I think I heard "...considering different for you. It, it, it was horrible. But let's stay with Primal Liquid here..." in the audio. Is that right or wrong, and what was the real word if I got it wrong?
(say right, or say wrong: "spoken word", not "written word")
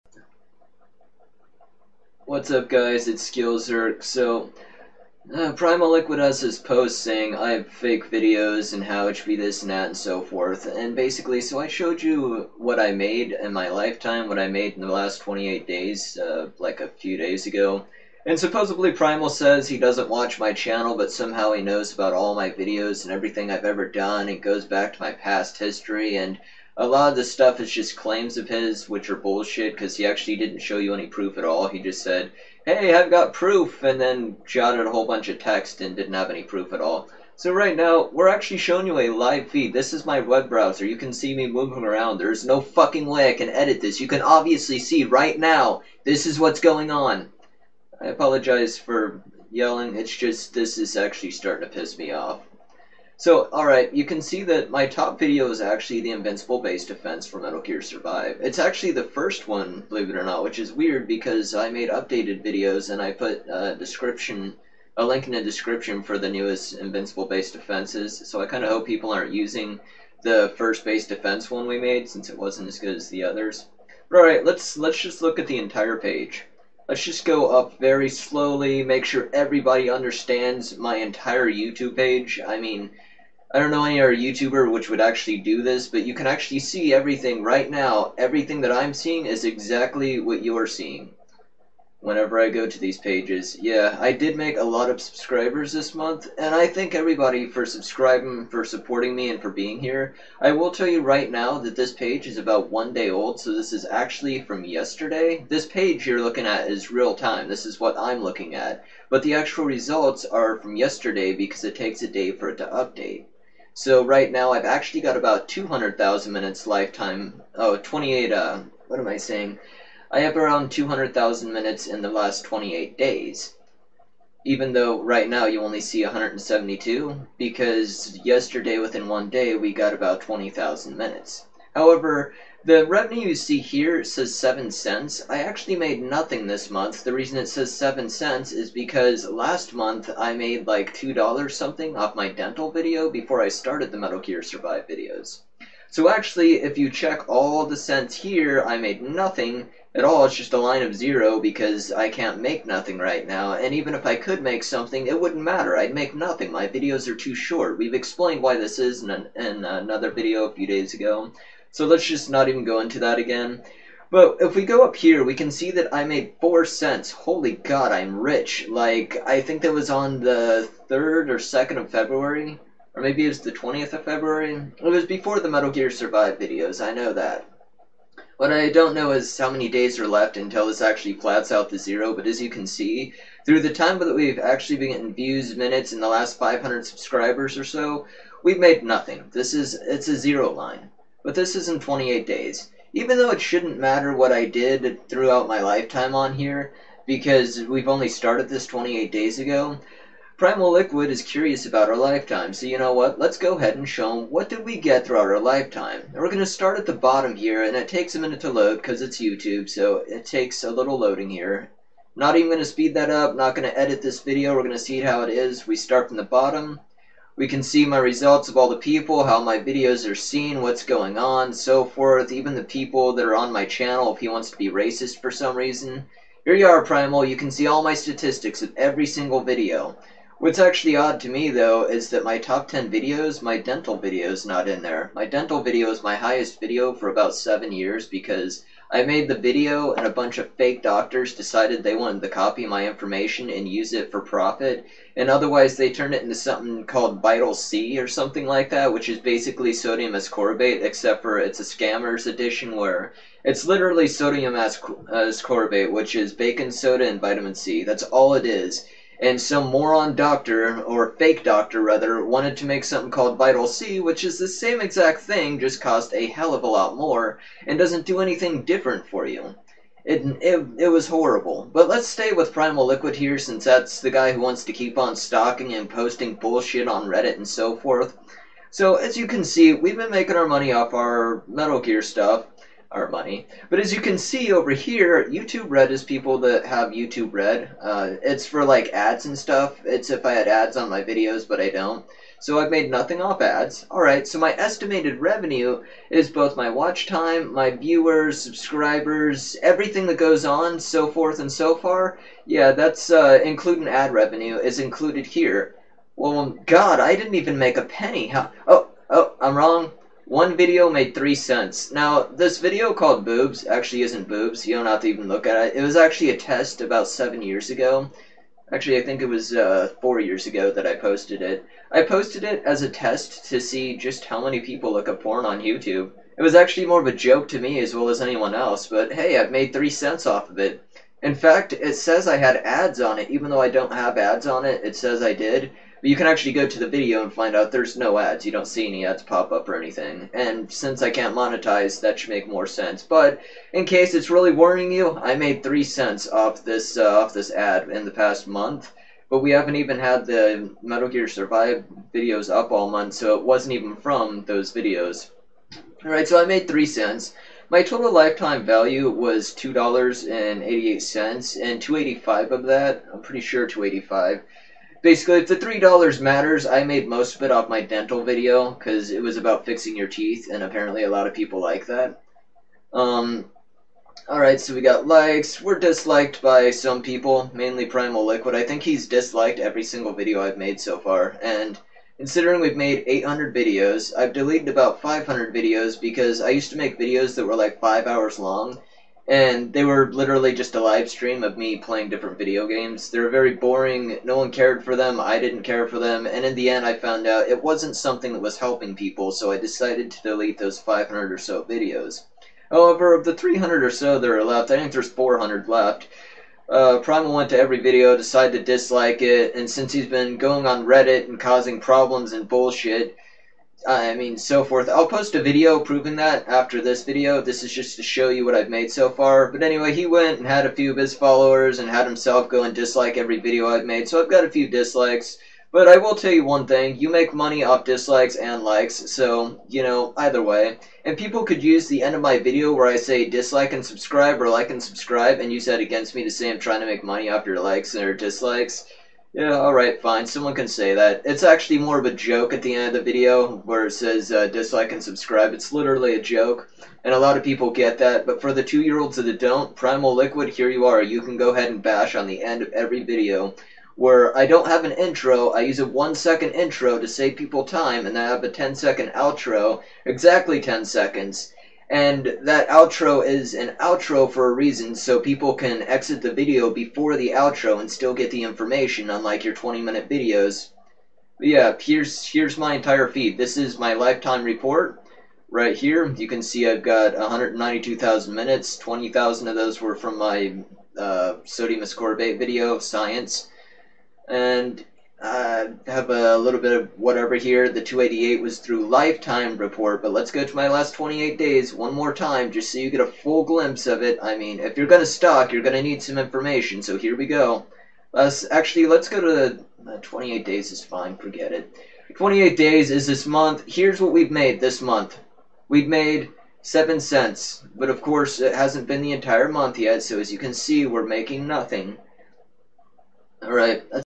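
wrong: "anything", not "considering".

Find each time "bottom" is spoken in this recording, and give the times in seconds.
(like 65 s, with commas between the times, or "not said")
206 s, 216 s.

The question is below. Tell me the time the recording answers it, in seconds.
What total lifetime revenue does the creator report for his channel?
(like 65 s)
359 s.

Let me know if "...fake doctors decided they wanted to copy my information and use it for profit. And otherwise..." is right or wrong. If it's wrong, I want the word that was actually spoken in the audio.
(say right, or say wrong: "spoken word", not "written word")
right.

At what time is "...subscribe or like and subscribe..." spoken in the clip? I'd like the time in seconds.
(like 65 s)
433 s.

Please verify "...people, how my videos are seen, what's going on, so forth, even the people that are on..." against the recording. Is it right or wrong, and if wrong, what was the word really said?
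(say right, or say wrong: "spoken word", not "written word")
right.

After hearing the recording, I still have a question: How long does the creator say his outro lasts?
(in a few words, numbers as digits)
10 seconds.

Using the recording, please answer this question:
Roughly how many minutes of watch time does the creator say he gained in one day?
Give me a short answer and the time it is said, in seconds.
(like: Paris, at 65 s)
20,000, at 129 s.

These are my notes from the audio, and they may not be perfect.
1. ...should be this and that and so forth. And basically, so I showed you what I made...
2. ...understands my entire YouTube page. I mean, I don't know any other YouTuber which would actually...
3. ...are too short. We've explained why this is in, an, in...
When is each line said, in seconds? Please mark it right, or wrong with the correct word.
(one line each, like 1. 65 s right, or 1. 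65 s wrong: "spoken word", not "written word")
1. 9 s right
2. 79 s right
3. 157 s right.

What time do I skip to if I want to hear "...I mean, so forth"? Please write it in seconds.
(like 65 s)
413 s.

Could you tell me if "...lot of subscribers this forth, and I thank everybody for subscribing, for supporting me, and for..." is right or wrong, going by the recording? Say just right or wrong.
wrong.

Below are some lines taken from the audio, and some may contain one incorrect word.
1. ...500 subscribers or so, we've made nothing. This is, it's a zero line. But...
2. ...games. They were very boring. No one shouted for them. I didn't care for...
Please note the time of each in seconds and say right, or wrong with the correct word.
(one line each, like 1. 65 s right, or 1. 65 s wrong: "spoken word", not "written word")
1. 186 s right
2. 392 s wrong: "cared", not "shouted".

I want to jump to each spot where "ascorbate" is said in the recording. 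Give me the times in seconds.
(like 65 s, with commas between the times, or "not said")
250 s, 254 s, 481 s.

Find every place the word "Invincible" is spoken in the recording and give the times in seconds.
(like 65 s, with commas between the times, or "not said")
56 s, 66 s.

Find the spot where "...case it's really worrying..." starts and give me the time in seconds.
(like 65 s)
343 s.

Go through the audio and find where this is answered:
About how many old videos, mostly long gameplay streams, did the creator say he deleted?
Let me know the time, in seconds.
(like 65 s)
384 s.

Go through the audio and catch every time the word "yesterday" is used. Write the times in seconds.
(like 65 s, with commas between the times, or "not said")
104 s, 110 s, 128 s.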